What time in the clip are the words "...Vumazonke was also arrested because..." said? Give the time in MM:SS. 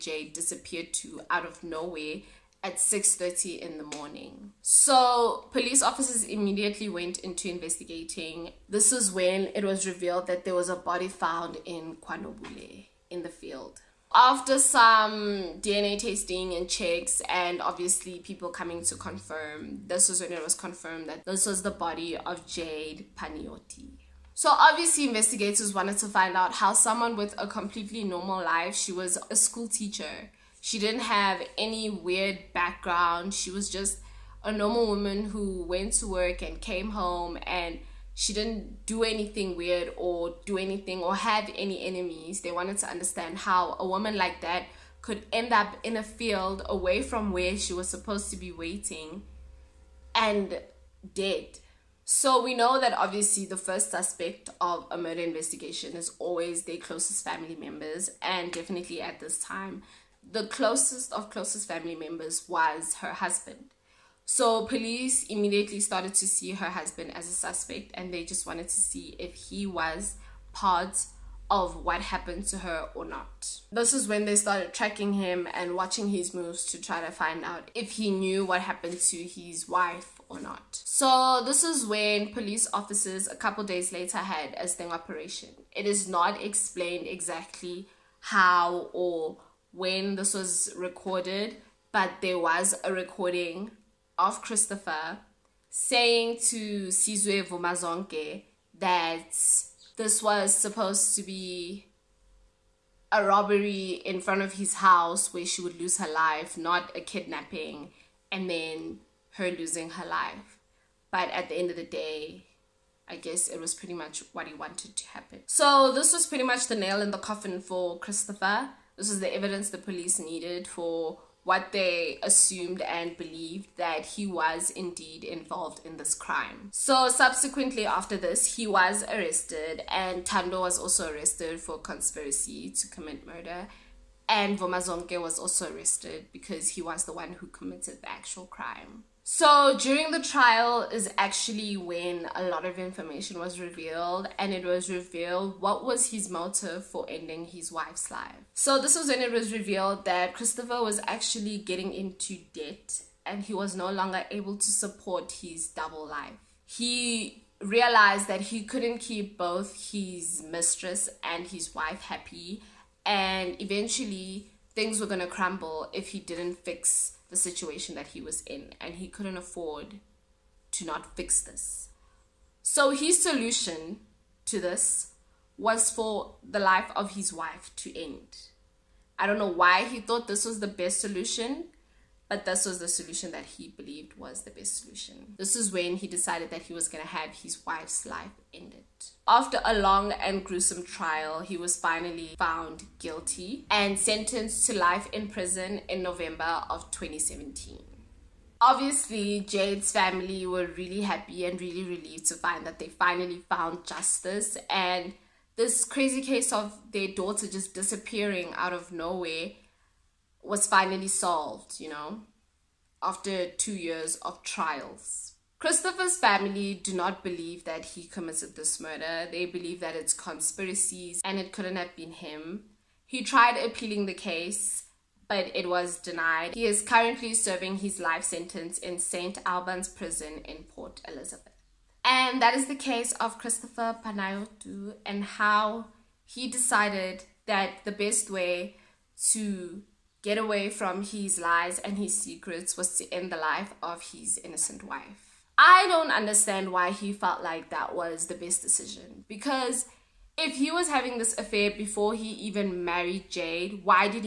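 02:14.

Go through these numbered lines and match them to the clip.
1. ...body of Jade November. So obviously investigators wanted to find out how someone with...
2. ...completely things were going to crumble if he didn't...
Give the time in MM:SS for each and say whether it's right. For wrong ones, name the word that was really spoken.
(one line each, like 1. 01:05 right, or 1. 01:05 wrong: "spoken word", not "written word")
1. 00:21 wrong: "Panayiotou", not "November"
2. 02:43 wrong: "eventually", not "completely".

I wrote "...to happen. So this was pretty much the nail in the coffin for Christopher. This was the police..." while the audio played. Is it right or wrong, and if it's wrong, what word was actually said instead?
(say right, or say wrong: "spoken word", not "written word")
wrong: "evidence", not "police".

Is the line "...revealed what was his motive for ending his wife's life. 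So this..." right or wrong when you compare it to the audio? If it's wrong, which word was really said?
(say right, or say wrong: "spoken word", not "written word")
right.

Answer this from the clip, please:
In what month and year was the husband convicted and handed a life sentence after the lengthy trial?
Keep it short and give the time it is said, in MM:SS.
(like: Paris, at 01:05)
November 2017, at 03:16.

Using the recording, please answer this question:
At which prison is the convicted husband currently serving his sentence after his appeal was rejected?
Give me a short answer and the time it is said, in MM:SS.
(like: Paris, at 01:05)
St. Albans Prison, at 03:48.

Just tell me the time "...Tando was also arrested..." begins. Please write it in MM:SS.
02:10.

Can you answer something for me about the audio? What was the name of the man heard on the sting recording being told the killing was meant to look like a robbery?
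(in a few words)
Sizwe Vumazonke.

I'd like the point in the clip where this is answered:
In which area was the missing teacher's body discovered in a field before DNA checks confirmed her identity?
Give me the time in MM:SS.
00:11.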